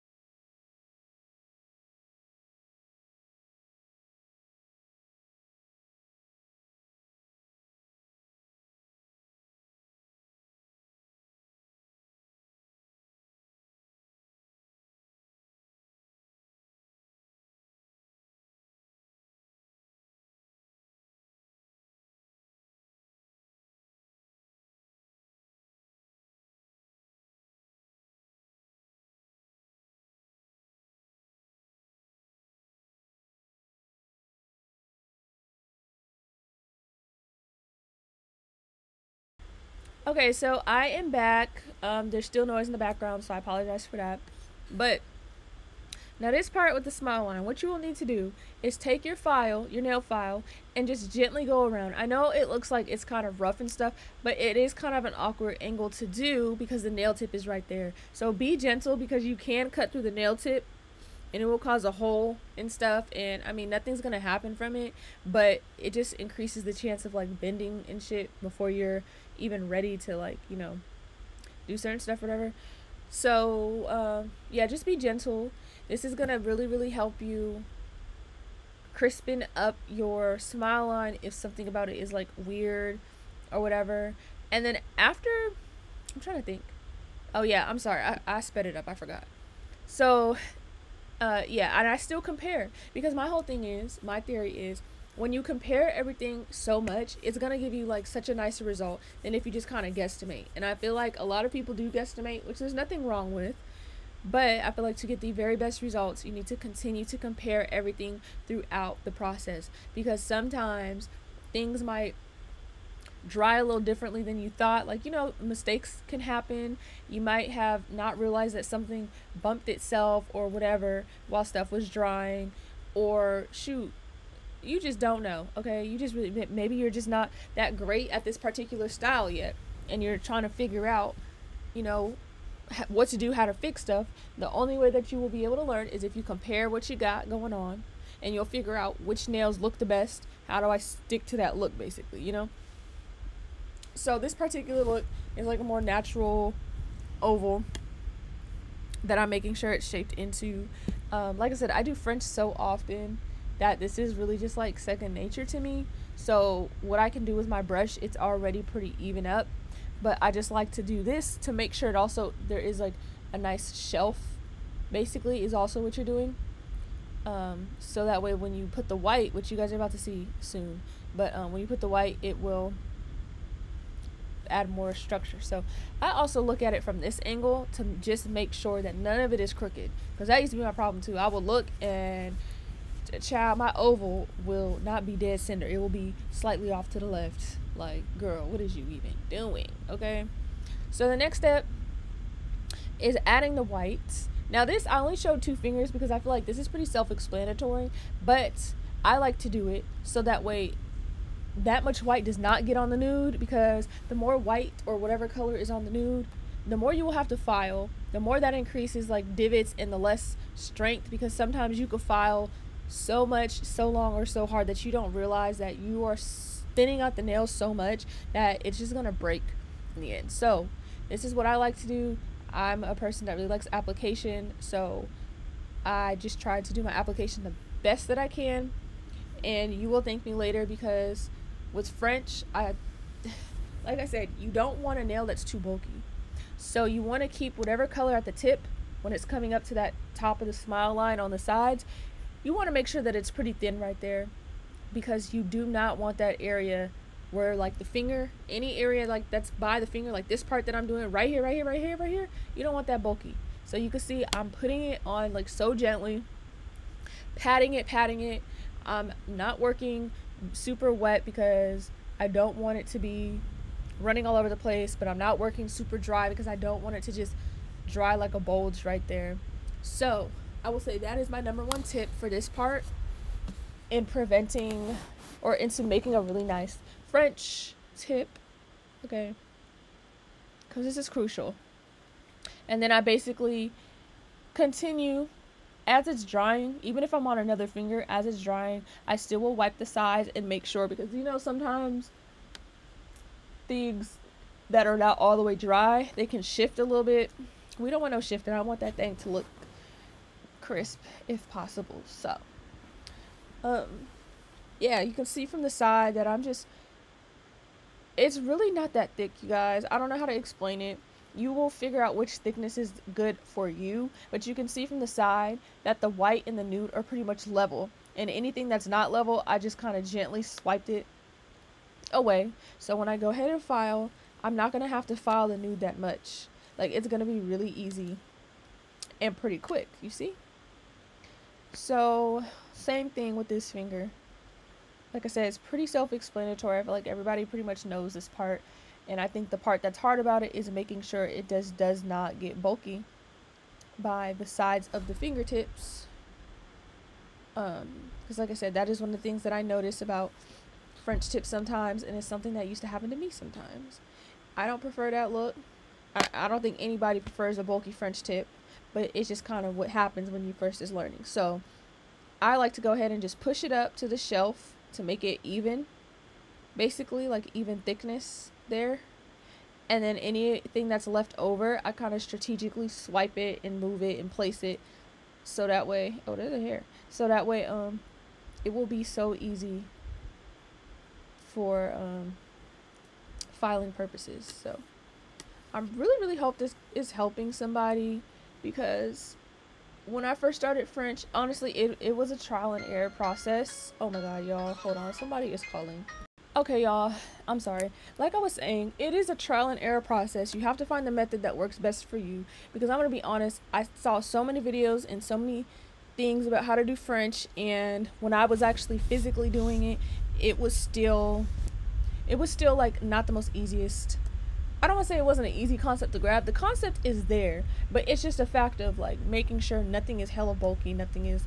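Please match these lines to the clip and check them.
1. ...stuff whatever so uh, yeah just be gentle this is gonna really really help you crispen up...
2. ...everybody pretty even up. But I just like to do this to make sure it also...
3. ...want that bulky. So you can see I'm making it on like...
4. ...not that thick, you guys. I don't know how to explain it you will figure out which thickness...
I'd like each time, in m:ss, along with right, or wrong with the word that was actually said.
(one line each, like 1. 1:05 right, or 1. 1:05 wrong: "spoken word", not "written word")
1. 1:11 right
2. 2:38 wrong: "already", not "everybody"
3. 4:12 wrong: "putting", not "making"
4. 5:08 right.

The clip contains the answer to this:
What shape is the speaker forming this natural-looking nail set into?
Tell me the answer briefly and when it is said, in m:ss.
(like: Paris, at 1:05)
natural oval, at 2:25.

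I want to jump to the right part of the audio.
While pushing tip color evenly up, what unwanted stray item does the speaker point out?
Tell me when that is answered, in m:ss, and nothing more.
6:16.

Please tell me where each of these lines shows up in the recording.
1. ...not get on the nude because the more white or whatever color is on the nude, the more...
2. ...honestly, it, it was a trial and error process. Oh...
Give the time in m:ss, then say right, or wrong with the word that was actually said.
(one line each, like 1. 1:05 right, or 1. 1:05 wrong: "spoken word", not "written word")
1. 3:22 right
2. 6:31 right.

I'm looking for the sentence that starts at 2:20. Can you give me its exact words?
How do I stick to that look, basically, you know?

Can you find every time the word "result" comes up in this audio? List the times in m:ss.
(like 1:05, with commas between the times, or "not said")
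1:38, 1:45.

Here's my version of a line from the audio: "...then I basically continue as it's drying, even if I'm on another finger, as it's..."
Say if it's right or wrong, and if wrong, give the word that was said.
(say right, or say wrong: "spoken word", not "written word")
right.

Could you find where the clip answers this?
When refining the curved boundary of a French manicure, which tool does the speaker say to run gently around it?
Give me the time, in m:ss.
0:49.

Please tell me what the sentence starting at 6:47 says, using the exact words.
And when I was actually physically doing it, it was still, it was still like not the most easiest.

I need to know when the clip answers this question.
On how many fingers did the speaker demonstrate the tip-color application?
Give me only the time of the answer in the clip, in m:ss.
3:15.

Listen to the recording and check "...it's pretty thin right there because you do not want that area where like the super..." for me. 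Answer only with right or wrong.
wrong.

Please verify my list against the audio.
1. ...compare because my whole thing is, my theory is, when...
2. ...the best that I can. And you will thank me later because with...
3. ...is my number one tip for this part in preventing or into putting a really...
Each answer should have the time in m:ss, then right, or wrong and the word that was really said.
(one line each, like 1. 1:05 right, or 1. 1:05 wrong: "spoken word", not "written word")
1. 1:32 right
2. 3:47 right
3. 4:31 wrong: "making", not "putting".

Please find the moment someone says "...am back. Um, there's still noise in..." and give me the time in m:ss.
0:40.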